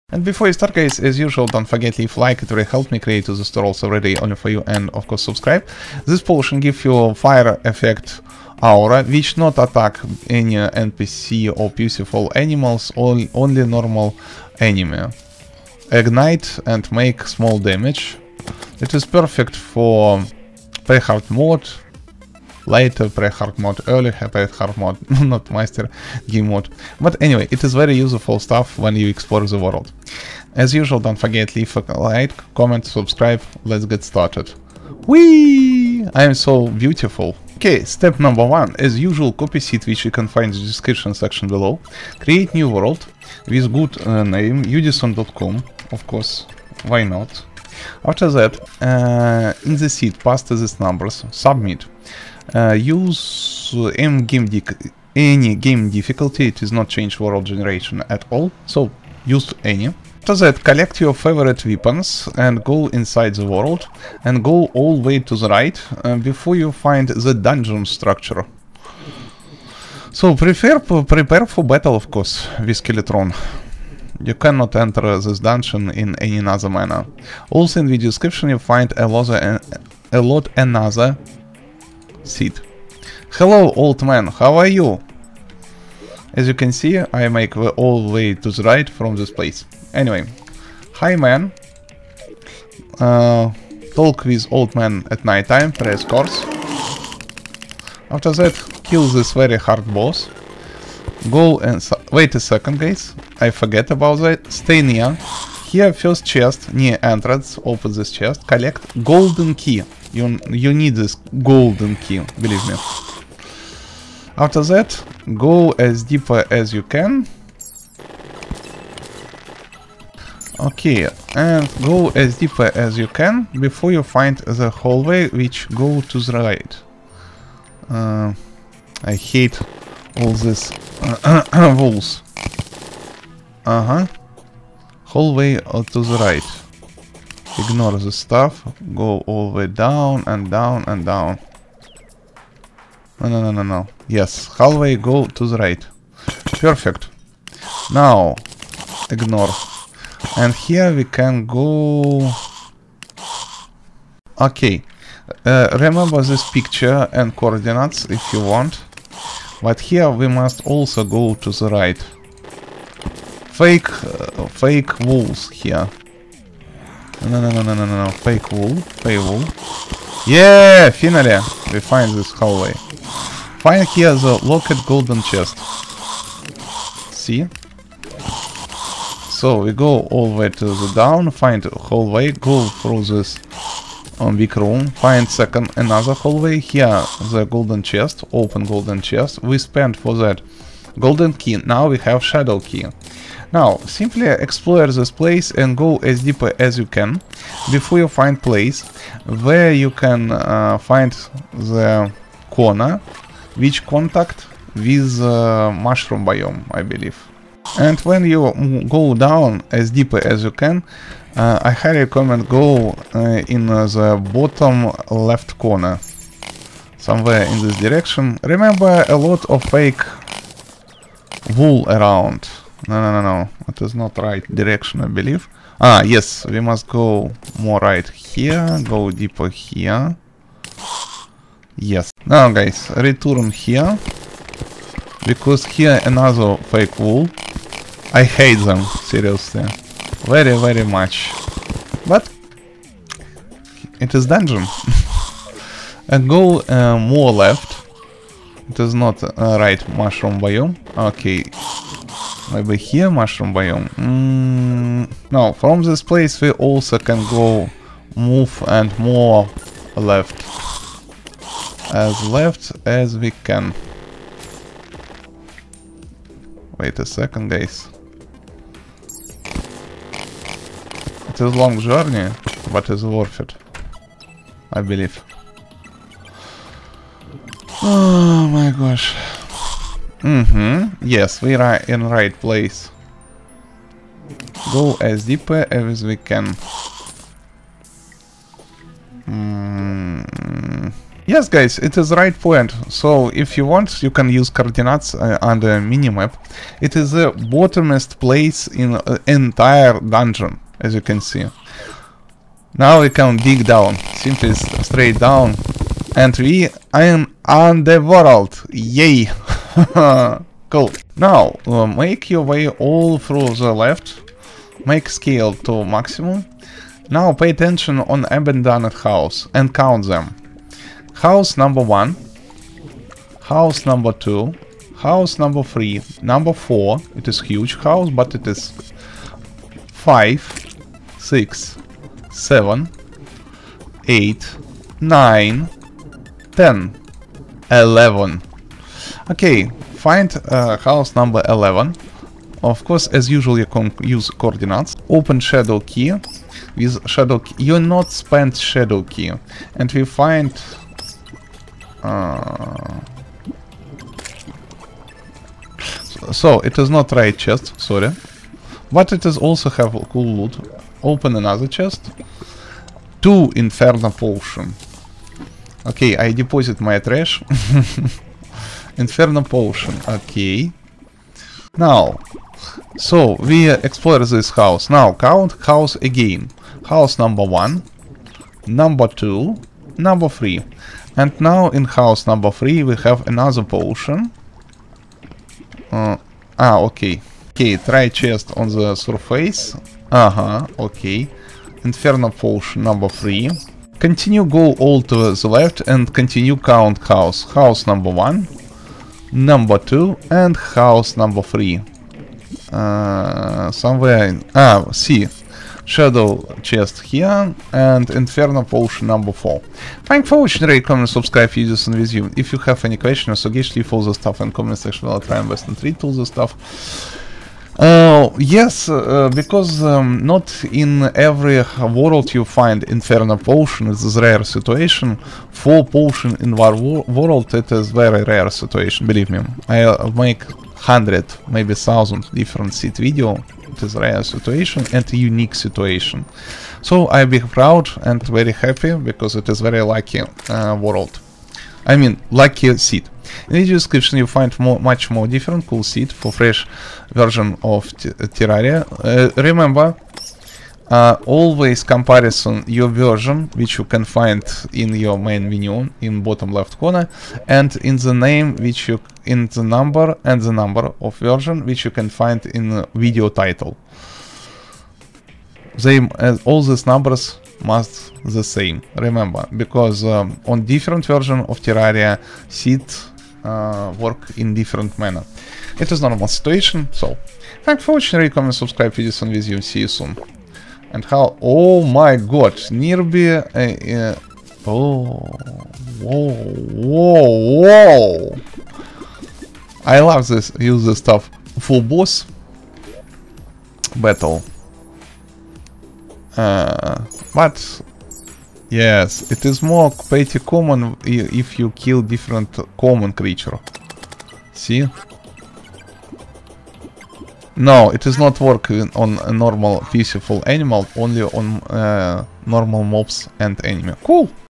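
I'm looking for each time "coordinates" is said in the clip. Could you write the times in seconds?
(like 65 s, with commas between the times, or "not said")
157 s, 294 s, 344 s.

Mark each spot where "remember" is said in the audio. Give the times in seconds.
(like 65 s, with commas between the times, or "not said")
155 s, 218 s, 449 s, 468 s.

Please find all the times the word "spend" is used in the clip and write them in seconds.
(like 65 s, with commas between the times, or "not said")
189 s, 348 s.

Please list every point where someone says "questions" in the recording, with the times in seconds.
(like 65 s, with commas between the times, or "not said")
412 s.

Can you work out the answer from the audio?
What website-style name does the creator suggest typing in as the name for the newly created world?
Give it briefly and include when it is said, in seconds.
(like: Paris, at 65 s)
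udisen.com, at 44 s.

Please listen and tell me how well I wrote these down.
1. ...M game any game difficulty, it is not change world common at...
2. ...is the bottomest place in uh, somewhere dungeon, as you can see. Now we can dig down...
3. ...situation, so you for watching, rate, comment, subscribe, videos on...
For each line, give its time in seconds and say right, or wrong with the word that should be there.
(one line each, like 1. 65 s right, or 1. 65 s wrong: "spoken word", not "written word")
1. 53 s wrong: "generation", not "common"
2. 296 s wrong: "entire", not "somewhere"
3. 476 s right.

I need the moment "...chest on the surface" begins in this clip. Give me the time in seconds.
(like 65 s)
388 s.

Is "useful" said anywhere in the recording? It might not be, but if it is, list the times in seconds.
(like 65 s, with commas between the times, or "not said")
28 s.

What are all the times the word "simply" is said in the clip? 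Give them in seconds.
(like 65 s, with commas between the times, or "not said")
193 s, 304 s.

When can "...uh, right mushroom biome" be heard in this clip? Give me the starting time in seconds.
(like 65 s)
249 s.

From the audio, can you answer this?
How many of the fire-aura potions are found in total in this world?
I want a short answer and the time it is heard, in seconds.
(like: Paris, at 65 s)
4, at 425 s.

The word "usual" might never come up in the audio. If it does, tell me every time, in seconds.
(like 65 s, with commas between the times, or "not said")
1 s, 30 s, 38 s, 343 s.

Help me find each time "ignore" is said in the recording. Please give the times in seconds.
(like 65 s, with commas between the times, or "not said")
137 s, 149 s.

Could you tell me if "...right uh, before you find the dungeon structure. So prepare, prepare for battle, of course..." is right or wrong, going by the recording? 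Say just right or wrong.
right.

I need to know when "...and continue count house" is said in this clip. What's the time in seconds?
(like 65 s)
395 s.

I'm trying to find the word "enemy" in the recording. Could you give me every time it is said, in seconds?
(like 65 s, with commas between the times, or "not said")
14 s, 513 s.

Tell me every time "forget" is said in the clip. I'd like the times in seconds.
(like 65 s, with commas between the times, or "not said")
1 s, 31 s, 103 s.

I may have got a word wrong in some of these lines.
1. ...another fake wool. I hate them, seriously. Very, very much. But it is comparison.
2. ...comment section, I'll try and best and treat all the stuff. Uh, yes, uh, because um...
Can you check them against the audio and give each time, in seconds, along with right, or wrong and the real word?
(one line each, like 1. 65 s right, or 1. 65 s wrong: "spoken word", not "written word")
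1. 236 s wrong: "dungeon", not "comparison"
2. 414 s right.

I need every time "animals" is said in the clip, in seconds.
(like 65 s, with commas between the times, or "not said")
12 s, 510 s.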